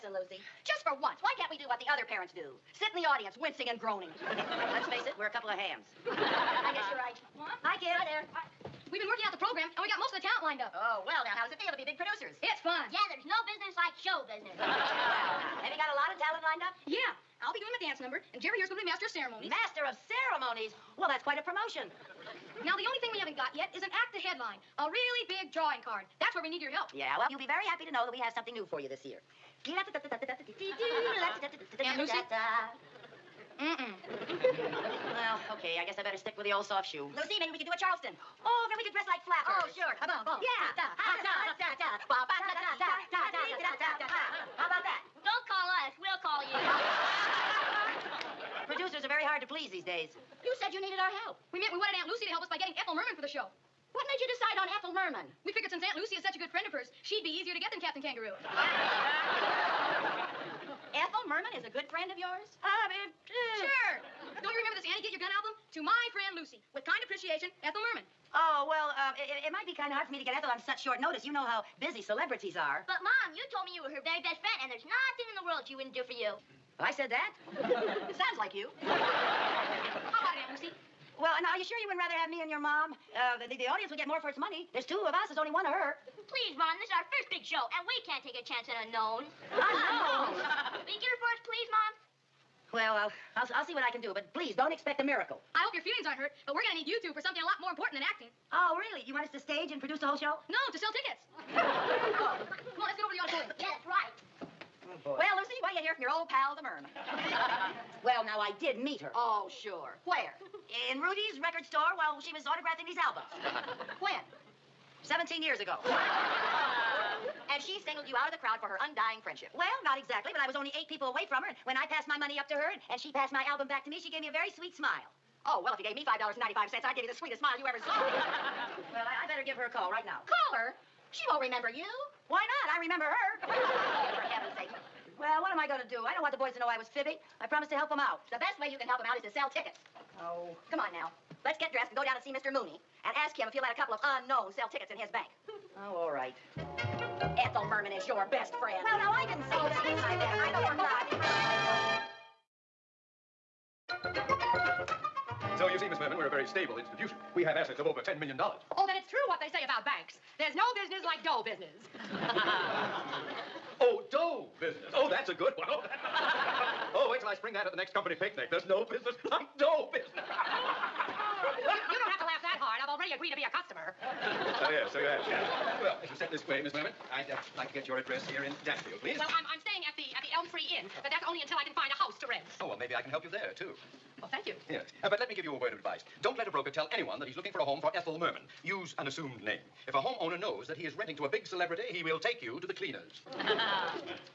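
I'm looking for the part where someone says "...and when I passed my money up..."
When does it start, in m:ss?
2:01.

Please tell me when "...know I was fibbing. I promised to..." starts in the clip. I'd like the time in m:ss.
2:16.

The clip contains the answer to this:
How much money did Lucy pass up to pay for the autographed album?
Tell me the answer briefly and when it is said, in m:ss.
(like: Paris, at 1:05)
$5.95, at 2:06.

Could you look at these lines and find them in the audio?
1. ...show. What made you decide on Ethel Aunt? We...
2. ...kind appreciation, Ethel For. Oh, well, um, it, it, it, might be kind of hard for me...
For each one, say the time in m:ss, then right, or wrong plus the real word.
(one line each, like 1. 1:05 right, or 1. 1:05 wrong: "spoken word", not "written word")
1. 0:53 wrong: "Merman", not "Aunt"
2. 1:06 wrong: "Merman", not "For".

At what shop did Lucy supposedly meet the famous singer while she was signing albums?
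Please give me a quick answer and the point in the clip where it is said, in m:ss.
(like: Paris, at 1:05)
Rudy's record store, at 1:51.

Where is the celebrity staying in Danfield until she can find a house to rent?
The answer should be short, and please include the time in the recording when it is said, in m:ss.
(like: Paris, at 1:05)
Elm Tree Inn, at 3:00.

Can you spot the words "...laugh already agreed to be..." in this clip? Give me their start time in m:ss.
2:52.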